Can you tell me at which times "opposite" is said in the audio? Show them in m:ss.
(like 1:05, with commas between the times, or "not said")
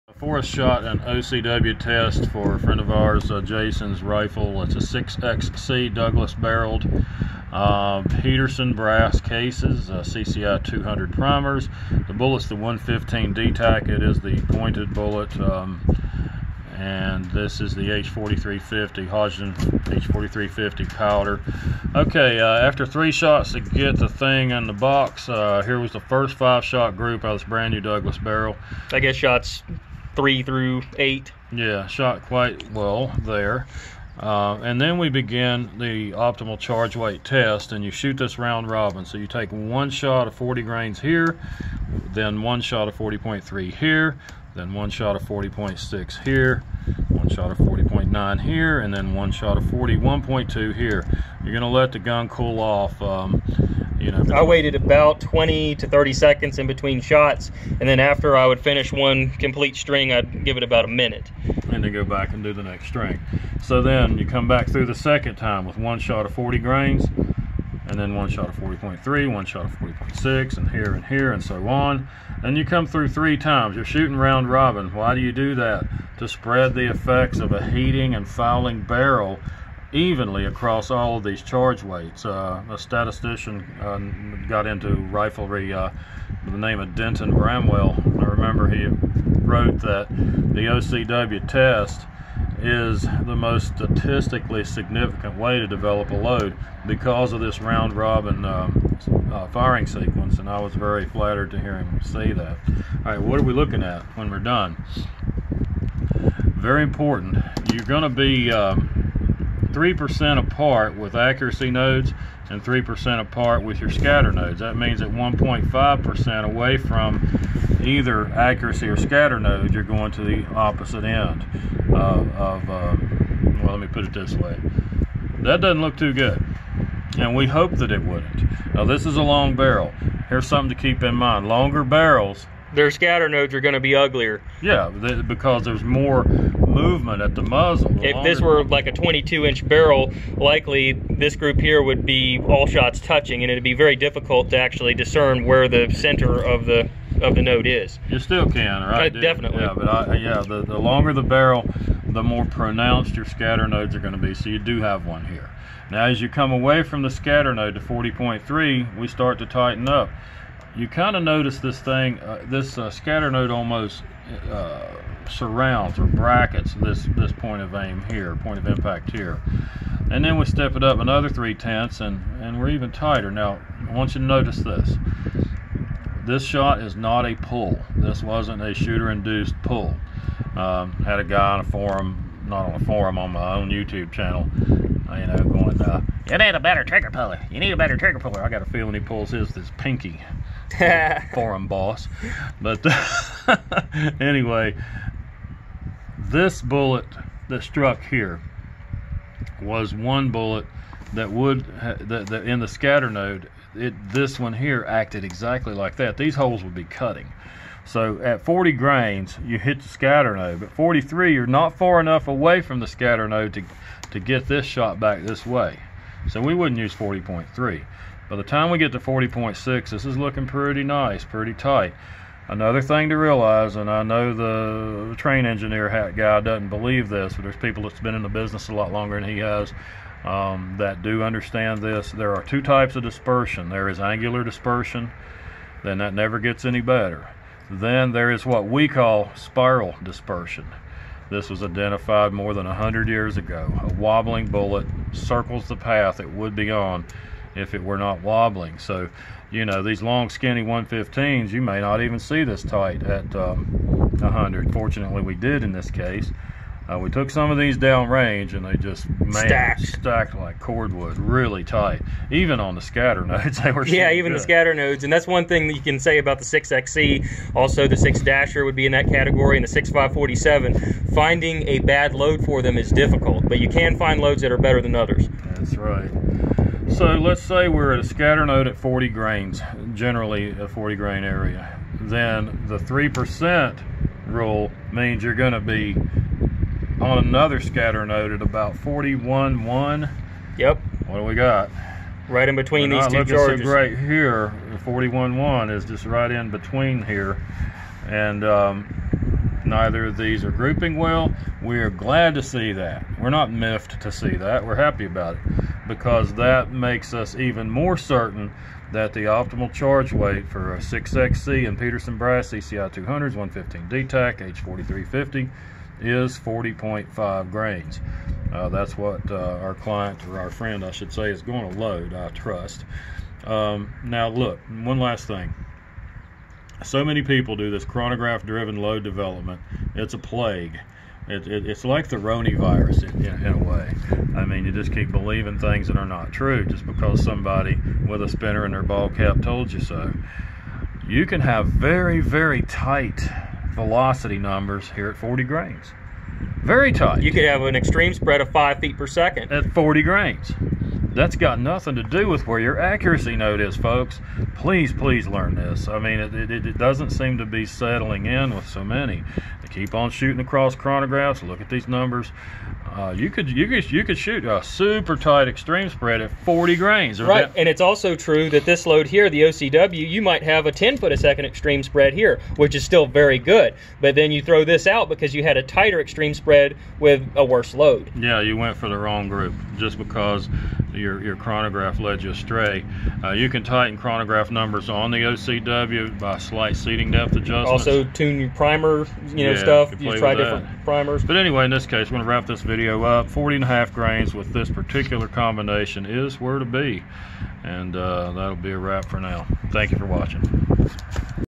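2:00.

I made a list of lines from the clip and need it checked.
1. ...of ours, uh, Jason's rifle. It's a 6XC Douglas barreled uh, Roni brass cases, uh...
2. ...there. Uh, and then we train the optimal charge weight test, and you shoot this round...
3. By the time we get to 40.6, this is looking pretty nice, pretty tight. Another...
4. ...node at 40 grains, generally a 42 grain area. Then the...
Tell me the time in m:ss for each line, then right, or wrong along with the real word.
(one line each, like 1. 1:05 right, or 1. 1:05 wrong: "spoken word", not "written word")
1. 0:02 wrong: "Peterson", not "Roni"
2. 0:33 wrong: "begin", not "train"
3. 3:38 right
4. 4:38 wrong: "40", not "42".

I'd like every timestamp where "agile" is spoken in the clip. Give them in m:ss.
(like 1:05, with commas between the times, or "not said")
not said.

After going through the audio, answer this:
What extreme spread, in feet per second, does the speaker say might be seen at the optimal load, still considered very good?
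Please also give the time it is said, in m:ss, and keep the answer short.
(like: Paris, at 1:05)
10, at 6:10.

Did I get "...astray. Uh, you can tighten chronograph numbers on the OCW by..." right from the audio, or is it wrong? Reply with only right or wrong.
right.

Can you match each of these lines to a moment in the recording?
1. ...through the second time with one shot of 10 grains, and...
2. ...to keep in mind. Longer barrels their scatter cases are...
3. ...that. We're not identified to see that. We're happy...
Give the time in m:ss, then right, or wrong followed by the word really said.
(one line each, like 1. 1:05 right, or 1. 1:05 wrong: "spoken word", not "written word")
1. 1:04 wrong: "40", not "10"
2. 2:10 wrong: "nodes", not "cases"
3. 5:02 wrong: "miffed", not "identified".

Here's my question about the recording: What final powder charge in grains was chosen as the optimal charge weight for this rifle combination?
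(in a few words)
40.5 grains.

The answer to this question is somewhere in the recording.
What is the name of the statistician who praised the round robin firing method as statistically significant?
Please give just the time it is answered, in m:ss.
1:26.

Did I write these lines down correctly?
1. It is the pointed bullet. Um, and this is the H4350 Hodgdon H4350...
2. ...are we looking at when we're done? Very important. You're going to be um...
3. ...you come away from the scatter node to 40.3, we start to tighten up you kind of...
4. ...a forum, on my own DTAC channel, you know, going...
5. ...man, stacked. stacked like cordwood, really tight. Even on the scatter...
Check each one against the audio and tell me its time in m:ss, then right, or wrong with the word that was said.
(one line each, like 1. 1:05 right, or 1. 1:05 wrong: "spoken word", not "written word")
1. 0:13 right
2. 1:43 right
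3. 2:36 right
4. 3:02 wrong: "YouTube", not "DTAC"
5. 4:19 right.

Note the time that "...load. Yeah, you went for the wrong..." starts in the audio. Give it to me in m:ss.
6:17.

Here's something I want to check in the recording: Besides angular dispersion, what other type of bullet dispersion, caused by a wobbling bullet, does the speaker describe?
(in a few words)
spiral dispersion.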